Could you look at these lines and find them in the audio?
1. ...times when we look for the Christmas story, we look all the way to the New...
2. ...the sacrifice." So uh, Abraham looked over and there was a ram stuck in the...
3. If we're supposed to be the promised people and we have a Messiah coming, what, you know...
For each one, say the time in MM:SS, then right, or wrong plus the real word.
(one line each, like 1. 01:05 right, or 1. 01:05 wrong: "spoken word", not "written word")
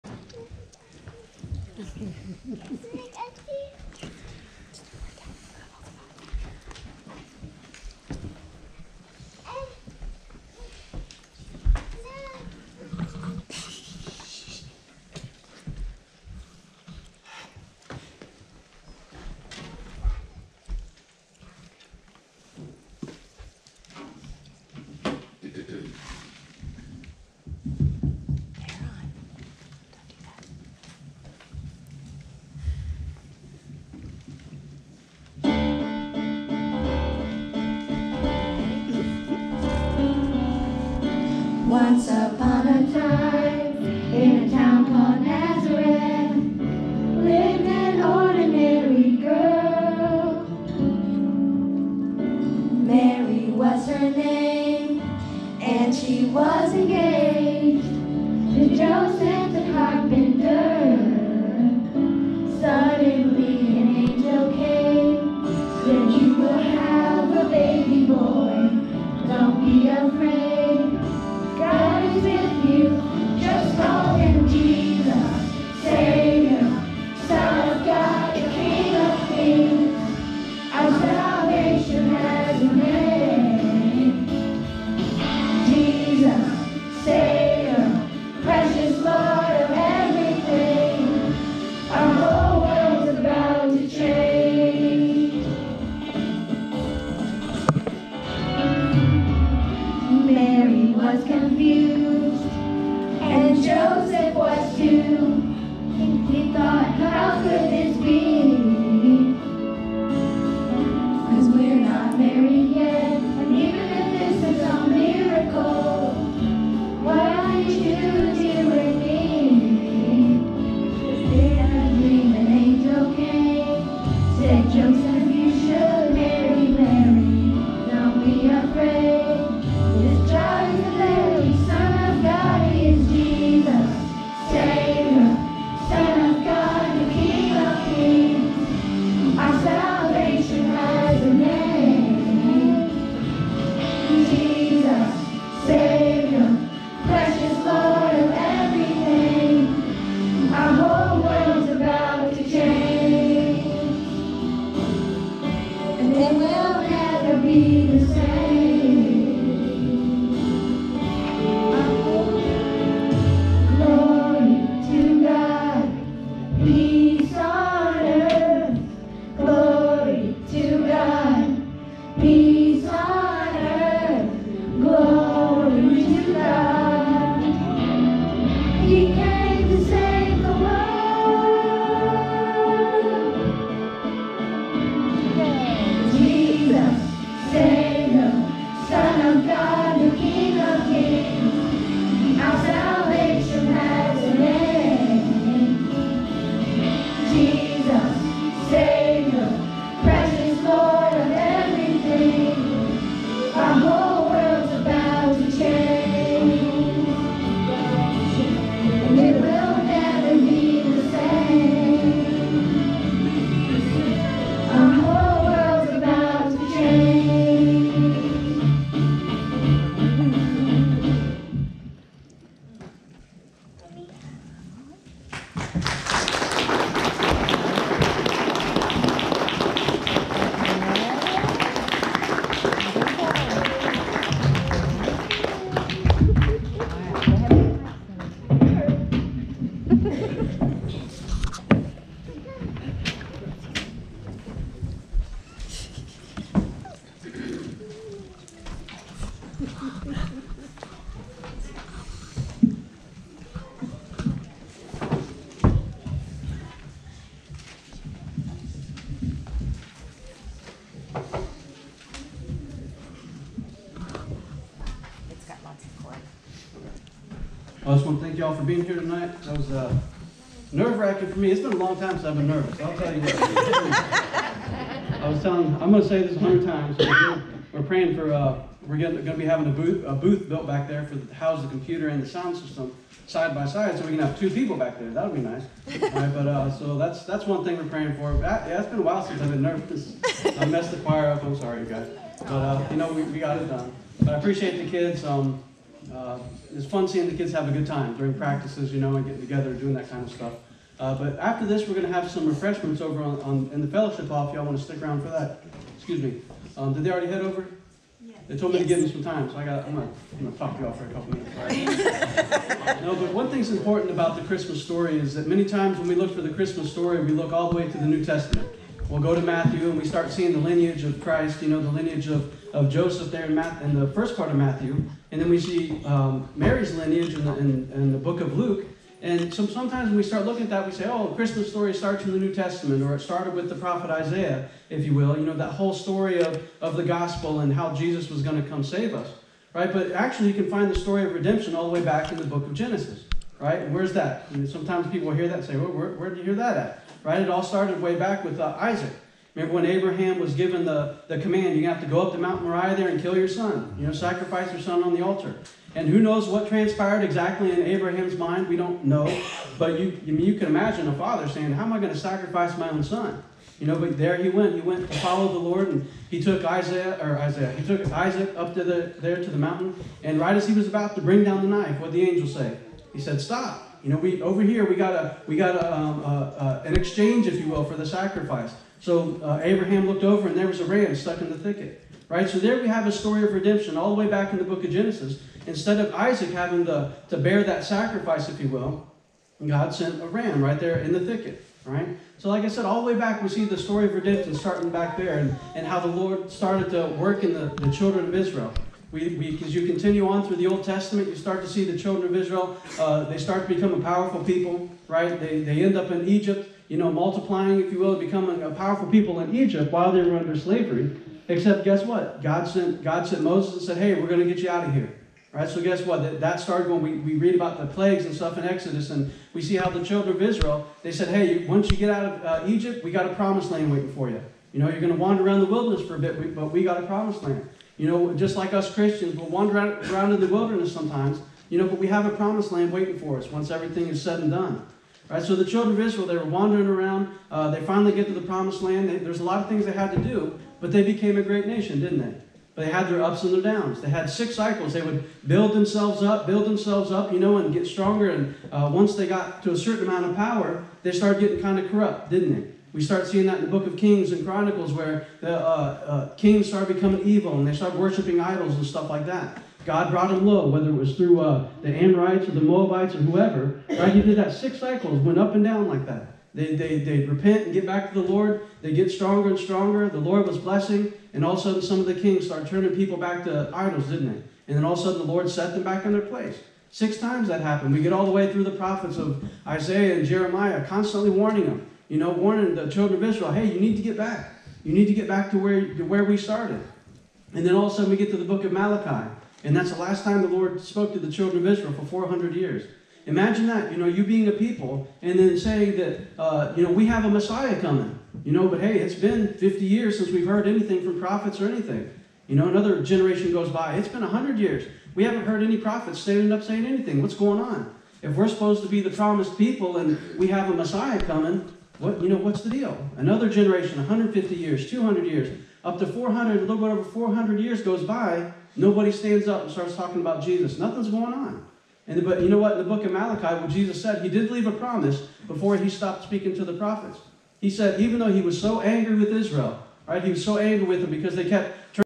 1. 05:15 right
2. 06:17 right
3. 08:28 right.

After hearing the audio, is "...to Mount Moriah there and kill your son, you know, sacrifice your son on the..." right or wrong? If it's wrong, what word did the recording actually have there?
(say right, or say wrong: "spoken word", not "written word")
right.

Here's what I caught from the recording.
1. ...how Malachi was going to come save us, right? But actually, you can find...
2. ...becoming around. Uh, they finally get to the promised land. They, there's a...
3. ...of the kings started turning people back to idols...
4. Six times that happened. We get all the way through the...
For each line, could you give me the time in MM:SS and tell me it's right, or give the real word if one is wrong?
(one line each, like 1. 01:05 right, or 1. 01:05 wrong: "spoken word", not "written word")
1. 05:37 wrong: "Jesus", not "Malachi"
2. 07:16 wrong: "wandering", not "becoming"
3. 07:52 right
4. 07:56 right.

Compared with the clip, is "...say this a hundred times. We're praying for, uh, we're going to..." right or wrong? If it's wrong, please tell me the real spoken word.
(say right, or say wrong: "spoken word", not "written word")
right.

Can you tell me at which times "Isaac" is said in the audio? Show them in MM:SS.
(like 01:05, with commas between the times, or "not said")
05:48, 06:08, 06:26.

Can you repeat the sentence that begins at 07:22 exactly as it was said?
But they had their ups and their downs.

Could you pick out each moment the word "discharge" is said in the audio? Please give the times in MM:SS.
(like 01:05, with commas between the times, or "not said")
not said.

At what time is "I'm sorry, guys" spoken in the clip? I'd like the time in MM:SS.
04:51.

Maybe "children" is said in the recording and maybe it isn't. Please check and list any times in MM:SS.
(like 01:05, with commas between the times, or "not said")
06:37, 06:41, 07:00, 07:15, 08:02, 08:11.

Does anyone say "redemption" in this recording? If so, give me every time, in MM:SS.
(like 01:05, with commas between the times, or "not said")
05:41, 06:23, 06:34.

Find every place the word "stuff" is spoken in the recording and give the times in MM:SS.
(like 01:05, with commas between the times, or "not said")
05:00, 06:58, 07:38.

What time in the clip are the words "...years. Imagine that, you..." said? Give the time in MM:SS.
08:12.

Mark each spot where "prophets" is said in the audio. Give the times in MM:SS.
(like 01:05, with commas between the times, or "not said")
05:33, 07:58, 08:21, 08:25, 08:46.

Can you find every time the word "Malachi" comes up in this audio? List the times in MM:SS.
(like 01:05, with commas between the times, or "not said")
08:08, 08:43.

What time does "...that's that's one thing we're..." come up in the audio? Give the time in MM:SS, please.
04:46.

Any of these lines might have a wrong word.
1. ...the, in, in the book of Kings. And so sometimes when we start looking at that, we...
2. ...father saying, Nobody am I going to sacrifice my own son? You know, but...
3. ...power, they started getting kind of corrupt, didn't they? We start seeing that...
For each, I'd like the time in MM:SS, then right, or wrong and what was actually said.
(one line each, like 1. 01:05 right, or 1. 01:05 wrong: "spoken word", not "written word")
1. 05:27 wrong: "Luke", not "Kings"
2. 06:01 wrong: "How", not "Nobody"
3. 07:30 right.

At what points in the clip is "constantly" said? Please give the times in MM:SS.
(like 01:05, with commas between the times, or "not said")
08:00.